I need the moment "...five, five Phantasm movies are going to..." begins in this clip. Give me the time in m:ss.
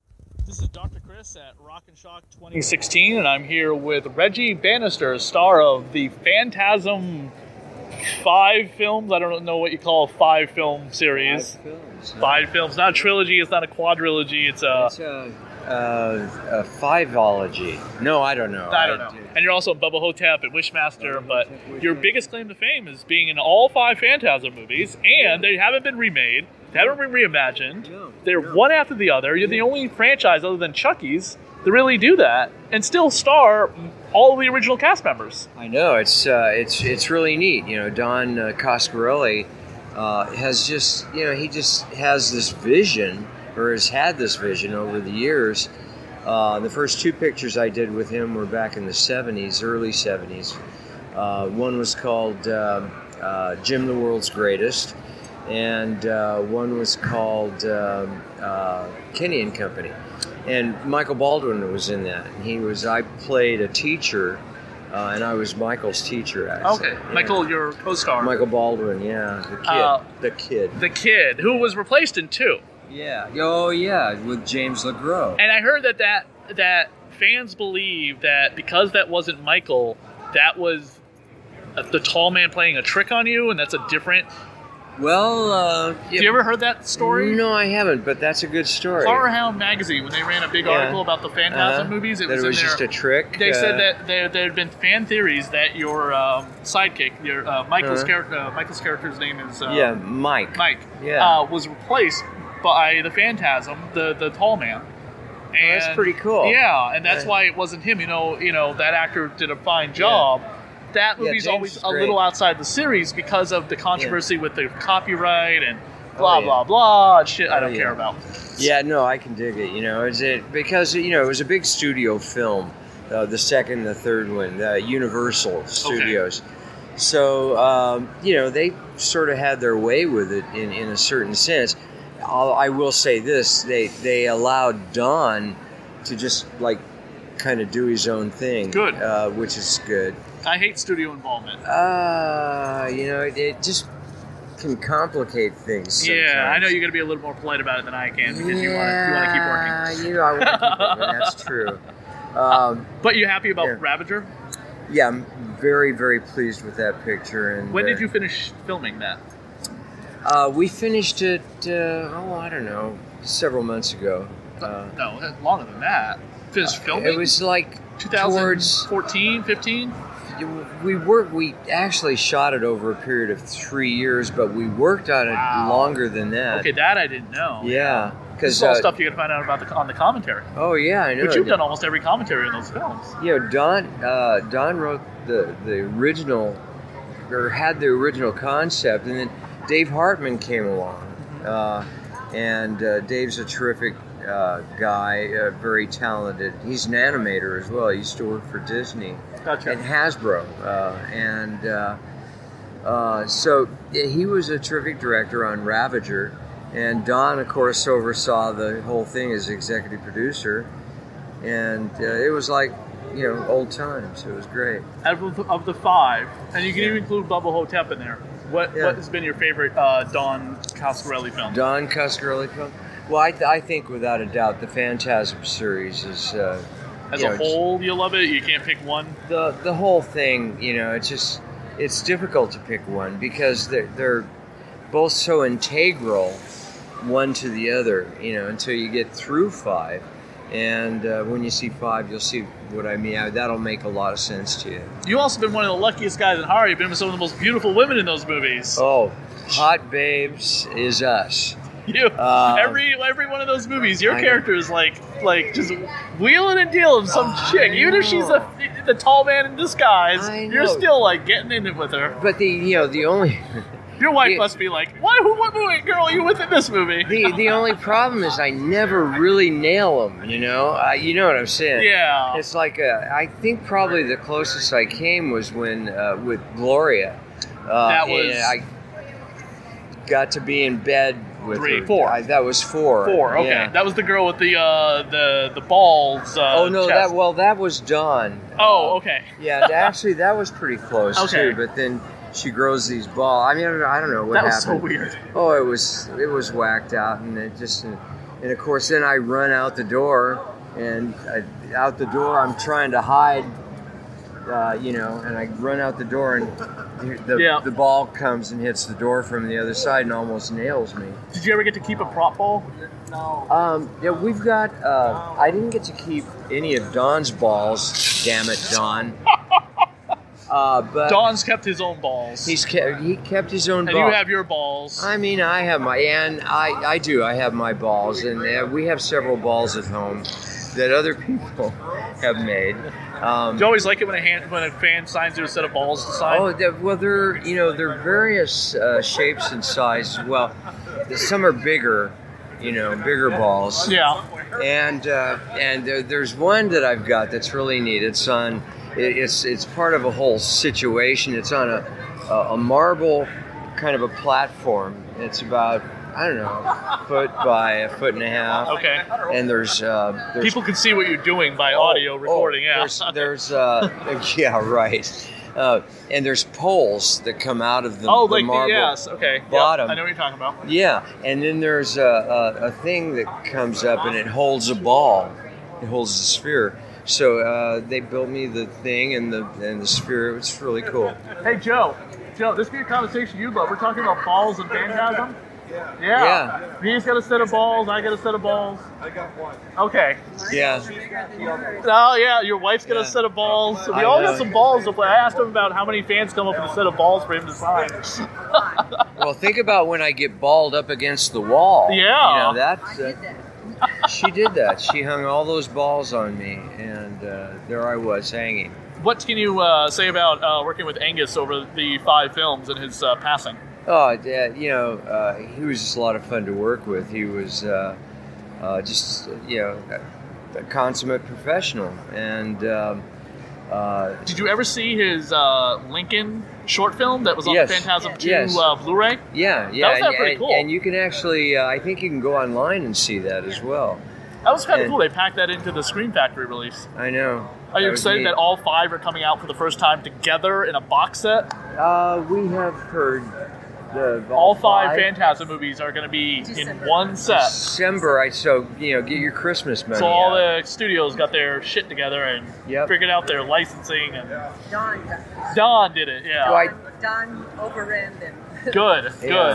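7:24.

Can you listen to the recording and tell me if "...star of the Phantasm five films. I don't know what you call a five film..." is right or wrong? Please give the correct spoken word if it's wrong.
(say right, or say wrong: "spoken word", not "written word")
right.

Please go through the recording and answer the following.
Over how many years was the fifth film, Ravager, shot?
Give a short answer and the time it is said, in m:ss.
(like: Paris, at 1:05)
3, at 2:53.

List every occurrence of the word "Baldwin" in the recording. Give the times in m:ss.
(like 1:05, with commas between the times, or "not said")
1:01, 1:08.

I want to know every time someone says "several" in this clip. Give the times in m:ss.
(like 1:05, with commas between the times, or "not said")
2:43, 5:28.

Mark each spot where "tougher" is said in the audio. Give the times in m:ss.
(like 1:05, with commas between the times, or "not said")
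not said.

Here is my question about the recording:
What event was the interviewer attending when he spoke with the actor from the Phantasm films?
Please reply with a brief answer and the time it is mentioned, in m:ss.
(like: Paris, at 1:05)
Rock and Shock 2016, at 0:01.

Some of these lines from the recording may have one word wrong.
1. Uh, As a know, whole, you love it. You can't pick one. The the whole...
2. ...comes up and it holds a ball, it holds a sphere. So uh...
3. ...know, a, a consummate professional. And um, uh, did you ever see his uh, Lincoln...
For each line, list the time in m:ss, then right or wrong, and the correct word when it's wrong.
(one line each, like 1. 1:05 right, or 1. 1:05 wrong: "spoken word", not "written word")
1. 3:46 right
2. 6:13 right
3. 6:59 right.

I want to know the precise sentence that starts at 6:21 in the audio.
Hey Joe, Joe, this be a conversation you love.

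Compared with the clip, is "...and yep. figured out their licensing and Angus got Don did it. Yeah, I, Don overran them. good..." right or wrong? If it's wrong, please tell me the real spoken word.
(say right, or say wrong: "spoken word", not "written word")
wrong: "Don", not "Angus".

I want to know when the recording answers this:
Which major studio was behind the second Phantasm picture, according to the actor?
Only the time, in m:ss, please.
2:04.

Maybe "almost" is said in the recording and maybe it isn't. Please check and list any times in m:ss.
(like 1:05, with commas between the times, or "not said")
3:01, 5:10.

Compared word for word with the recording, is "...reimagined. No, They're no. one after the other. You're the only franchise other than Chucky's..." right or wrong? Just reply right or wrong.
right.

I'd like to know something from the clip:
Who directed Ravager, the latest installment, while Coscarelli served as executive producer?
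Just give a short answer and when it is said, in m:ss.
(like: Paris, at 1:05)
Dave Hartman, at 3:09.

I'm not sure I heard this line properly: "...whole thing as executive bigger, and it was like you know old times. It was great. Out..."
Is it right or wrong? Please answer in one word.
wrong.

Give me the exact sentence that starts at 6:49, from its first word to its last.
What can you uh, say about uh, working with Angus over the five films and his uh, passing?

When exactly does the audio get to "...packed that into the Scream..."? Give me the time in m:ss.
7:15.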